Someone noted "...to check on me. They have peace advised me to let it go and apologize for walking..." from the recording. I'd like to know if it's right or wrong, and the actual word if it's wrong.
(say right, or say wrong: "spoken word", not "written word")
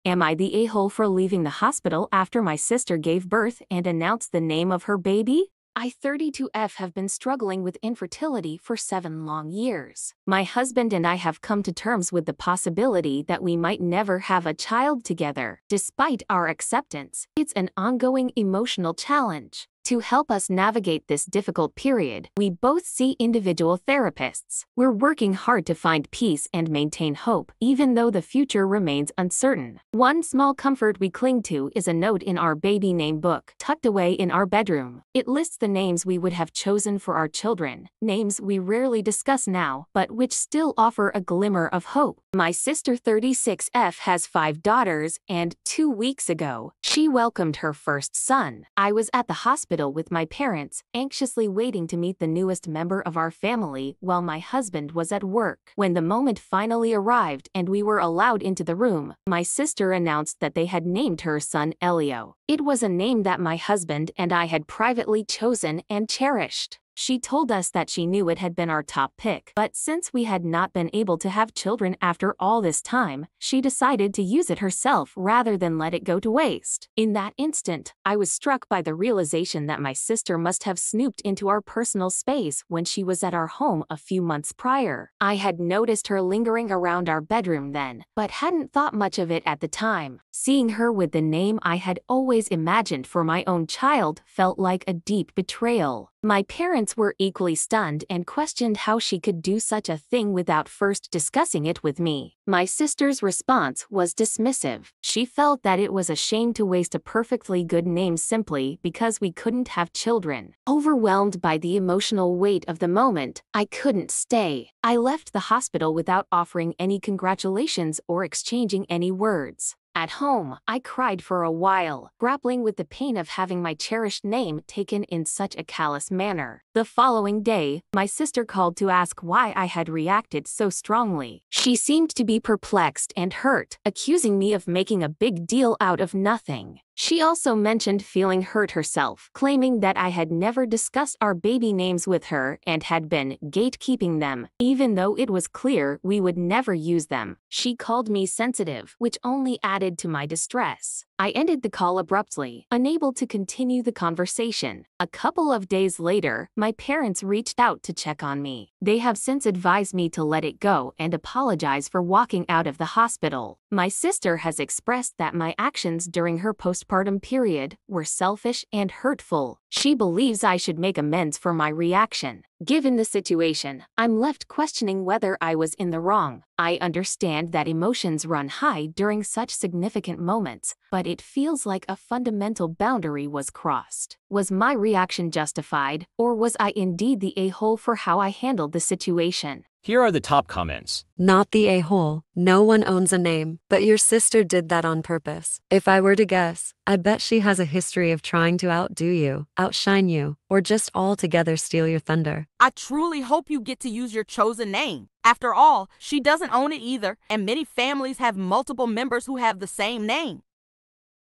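wrong: "since", not "peace".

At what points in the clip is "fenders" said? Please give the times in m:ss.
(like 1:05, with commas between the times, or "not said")
not said.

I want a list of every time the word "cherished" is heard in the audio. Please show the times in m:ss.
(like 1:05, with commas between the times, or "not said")
1:06, 2:03.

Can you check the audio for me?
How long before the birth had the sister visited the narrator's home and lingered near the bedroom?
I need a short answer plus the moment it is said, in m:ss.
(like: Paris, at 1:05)
a few months, at 1:23.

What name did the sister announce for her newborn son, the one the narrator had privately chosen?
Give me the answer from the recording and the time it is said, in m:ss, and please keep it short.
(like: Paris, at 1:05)
Elio, at 1:01.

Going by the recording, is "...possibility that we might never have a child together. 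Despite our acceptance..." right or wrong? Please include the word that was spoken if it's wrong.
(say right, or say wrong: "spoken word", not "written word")
right.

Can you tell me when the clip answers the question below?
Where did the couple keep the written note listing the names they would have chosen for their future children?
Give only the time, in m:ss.
0:32.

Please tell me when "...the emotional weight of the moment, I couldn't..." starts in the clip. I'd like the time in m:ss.
1:51.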